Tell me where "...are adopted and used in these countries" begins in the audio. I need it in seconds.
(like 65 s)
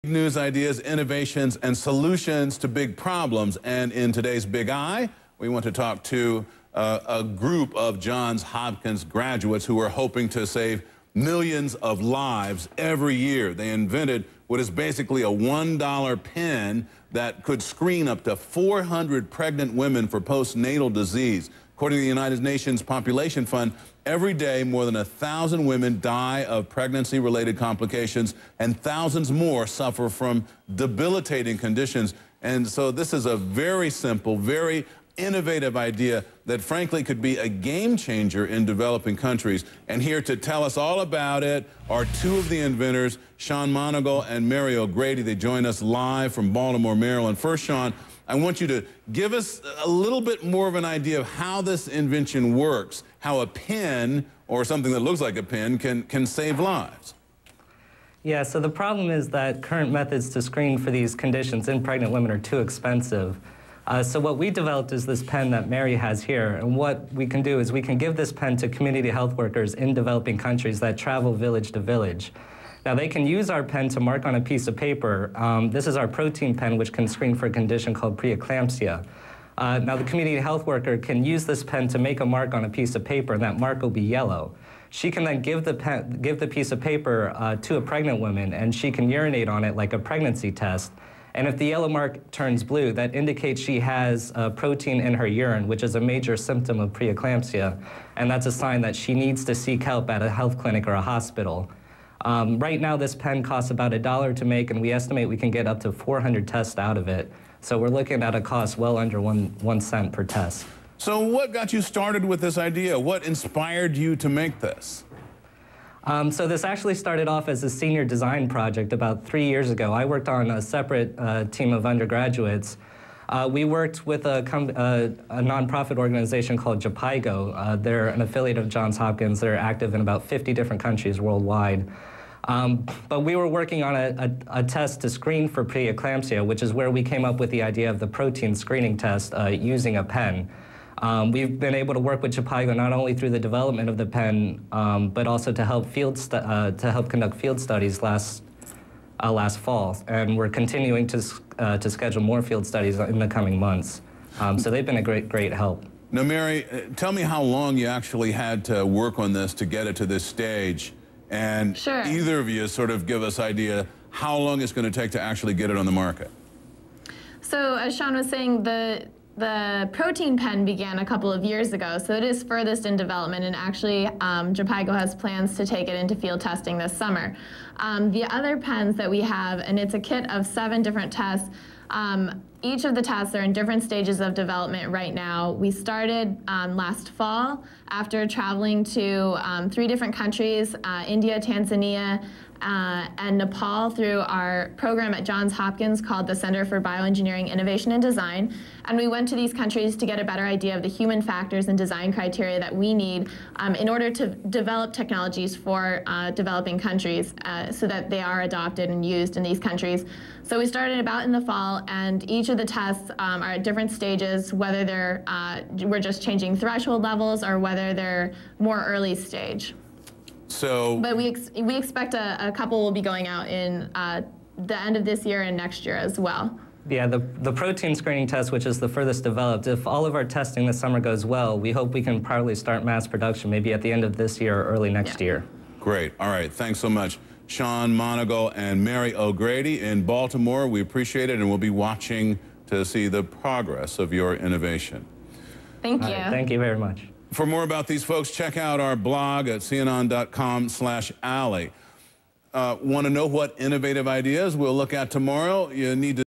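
208 s.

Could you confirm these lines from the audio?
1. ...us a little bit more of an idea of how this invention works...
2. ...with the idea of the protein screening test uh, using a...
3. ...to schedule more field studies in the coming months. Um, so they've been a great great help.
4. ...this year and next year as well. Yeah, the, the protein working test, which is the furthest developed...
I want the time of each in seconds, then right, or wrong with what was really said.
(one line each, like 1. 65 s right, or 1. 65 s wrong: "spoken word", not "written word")
1. 49 s right
2. 137 s right
3. 151 s right
4. 225 s wrong: "screening", not "working".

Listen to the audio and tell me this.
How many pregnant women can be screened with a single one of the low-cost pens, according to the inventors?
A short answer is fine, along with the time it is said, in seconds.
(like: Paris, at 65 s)
400, at 105 s.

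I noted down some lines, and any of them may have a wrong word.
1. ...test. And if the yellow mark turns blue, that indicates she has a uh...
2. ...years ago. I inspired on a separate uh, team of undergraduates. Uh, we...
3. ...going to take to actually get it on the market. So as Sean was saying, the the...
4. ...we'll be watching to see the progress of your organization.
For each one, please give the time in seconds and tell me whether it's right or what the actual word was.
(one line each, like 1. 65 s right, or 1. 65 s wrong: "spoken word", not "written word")
1. 90 s right
2. 119 s wrong: "worked", not "inspired"
3. 164 s right
4. 241 s wrong: "innovation", not "organization".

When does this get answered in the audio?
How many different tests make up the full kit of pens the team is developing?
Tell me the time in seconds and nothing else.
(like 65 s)
180 s.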